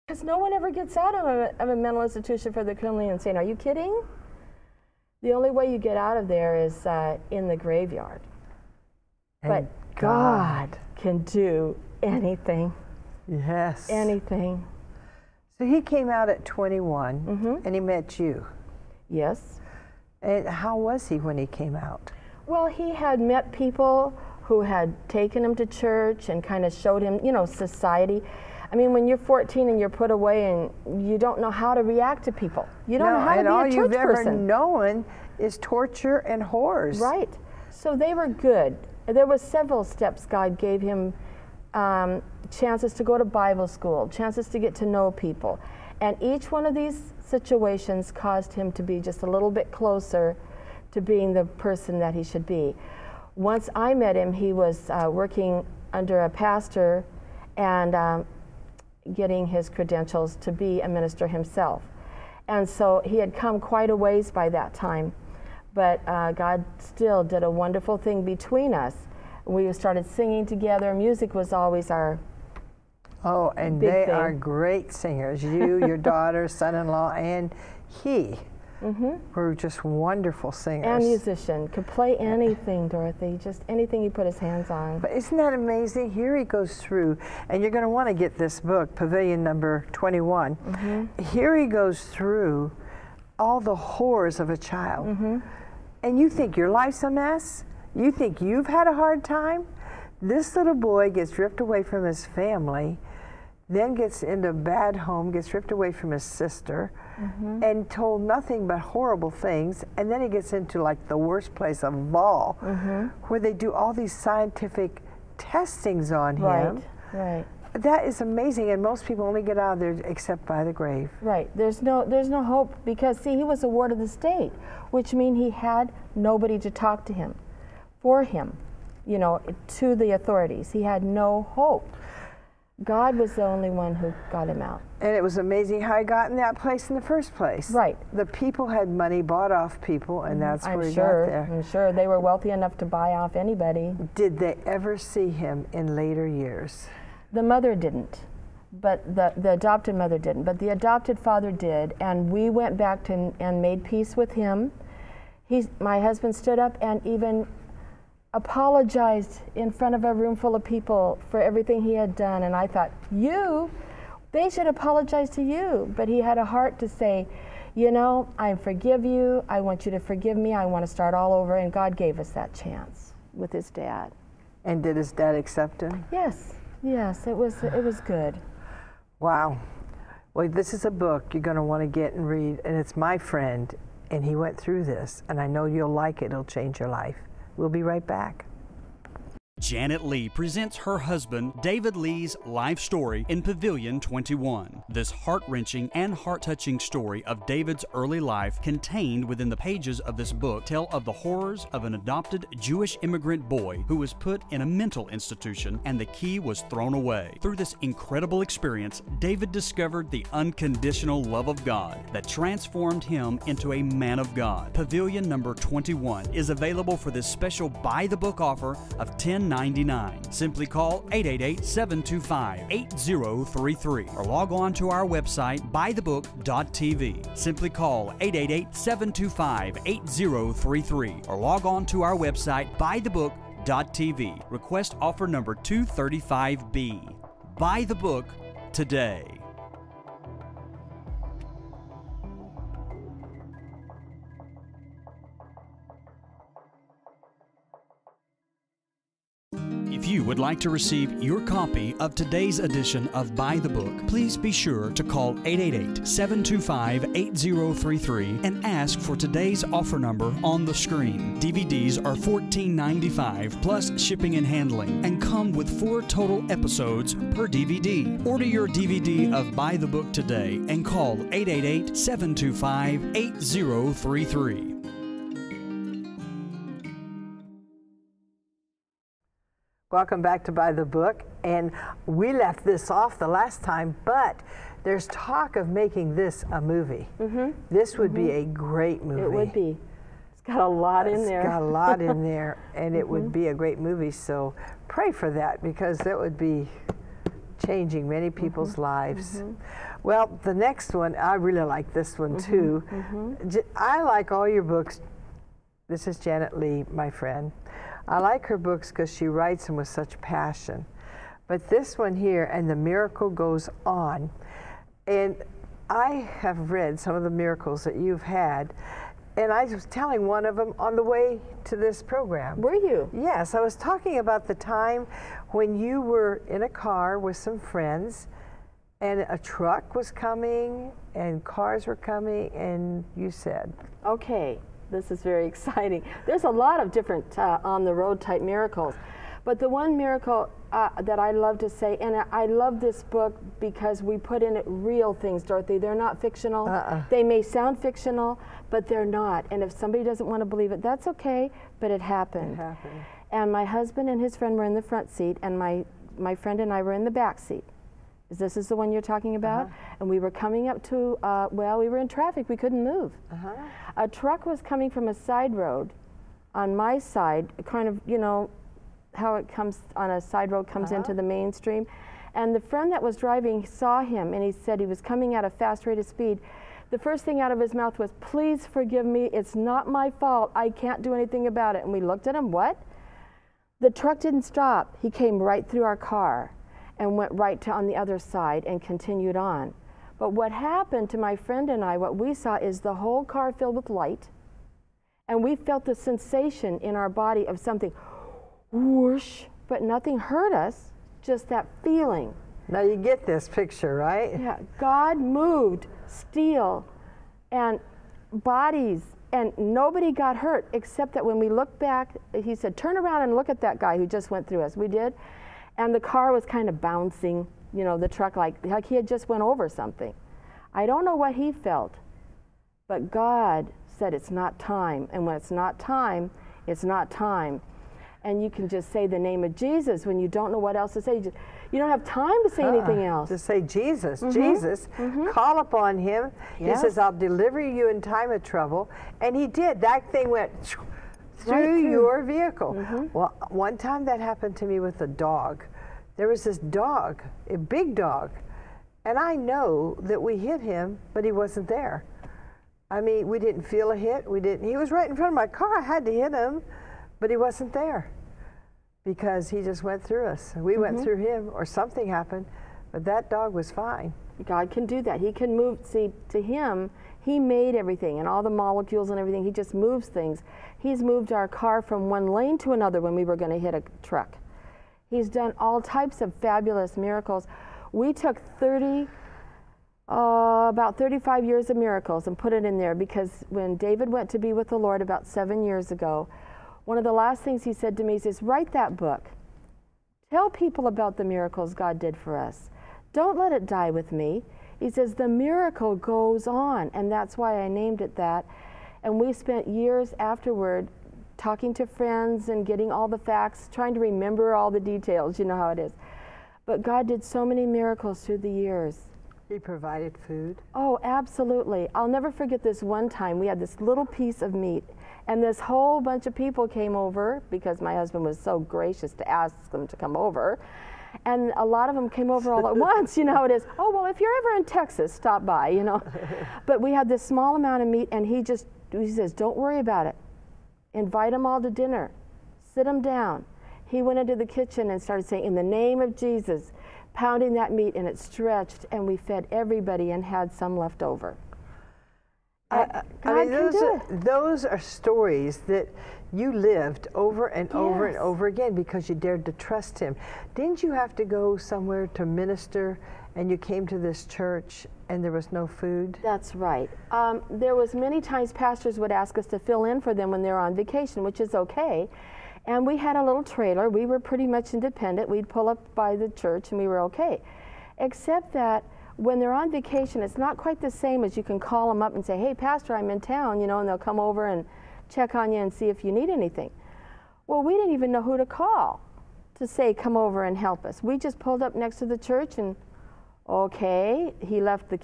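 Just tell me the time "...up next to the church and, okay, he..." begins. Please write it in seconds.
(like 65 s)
581 s.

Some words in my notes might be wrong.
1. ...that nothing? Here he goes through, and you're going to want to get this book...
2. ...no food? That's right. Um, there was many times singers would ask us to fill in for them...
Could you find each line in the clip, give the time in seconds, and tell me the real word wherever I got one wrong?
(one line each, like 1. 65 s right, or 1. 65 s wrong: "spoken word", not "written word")
1. 85 s wrong: "amazing", not "nothing"
2. 555 s wrong: "pastors", not "singers".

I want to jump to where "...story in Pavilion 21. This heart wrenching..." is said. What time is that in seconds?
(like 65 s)
192 s.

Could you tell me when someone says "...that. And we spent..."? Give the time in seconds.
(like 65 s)
498 s.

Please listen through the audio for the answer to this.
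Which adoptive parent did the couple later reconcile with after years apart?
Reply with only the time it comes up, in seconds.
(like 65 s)
150 s.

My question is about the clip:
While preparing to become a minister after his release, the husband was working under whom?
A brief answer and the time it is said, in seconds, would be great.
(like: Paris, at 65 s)
a pastor, at 55 s.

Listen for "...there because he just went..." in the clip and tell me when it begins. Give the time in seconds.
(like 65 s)
457 s.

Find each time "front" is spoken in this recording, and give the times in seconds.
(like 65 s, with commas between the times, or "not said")
159 s, 354 s, 455 s.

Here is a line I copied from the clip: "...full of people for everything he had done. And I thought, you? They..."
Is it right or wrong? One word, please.
right.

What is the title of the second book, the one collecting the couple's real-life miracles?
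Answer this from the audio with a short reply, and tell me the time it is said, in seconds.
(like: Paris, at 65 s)
And the Miracle Goes On, at 312 s.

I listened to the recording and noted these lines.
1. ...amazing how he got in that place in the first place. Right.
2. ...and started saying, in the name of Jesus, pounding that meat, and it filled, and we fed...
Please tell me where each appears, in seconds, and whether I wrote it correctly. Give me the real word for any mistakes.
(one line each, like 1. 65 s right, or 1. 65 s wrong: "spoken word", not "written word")
1. 135 s right
2. 534 s wrong: "stretched", not "filled".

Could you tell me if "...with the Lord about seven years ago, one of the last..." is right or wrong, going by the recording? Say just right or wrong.
right.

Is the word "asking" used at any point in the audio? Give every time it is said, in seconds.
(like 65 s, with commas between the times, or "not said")
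not said.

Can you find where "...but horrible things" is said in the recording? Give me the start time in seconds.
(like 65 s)
108 s.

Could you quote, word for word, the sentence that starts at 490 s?
Tell people about the miracles God did for us.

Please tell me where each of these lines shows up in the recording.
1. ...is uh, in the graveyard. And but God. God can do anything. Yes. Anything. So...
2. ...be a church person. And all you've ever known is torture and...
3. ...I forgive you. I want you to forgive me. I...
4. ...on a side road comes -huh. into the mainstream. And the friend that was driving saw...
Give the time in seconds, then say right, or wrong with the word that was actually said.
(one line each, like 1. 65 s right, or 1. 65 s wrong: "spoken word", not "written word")
1. 6 s right
2. 33 s right
3. 168 s right
4. 369 s right.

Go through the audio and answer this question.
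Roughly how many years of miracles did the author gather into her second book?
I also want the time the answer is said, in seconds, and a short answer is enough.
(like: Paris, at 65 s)
35, at 480 s.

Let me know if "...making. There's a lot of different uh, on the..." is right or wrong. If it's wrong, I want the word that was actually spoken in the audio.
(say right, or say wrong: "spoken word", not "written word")
wrong: "exciting", not "making".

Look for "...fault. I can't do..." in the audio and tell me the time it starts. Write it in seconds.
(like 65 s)
380 s.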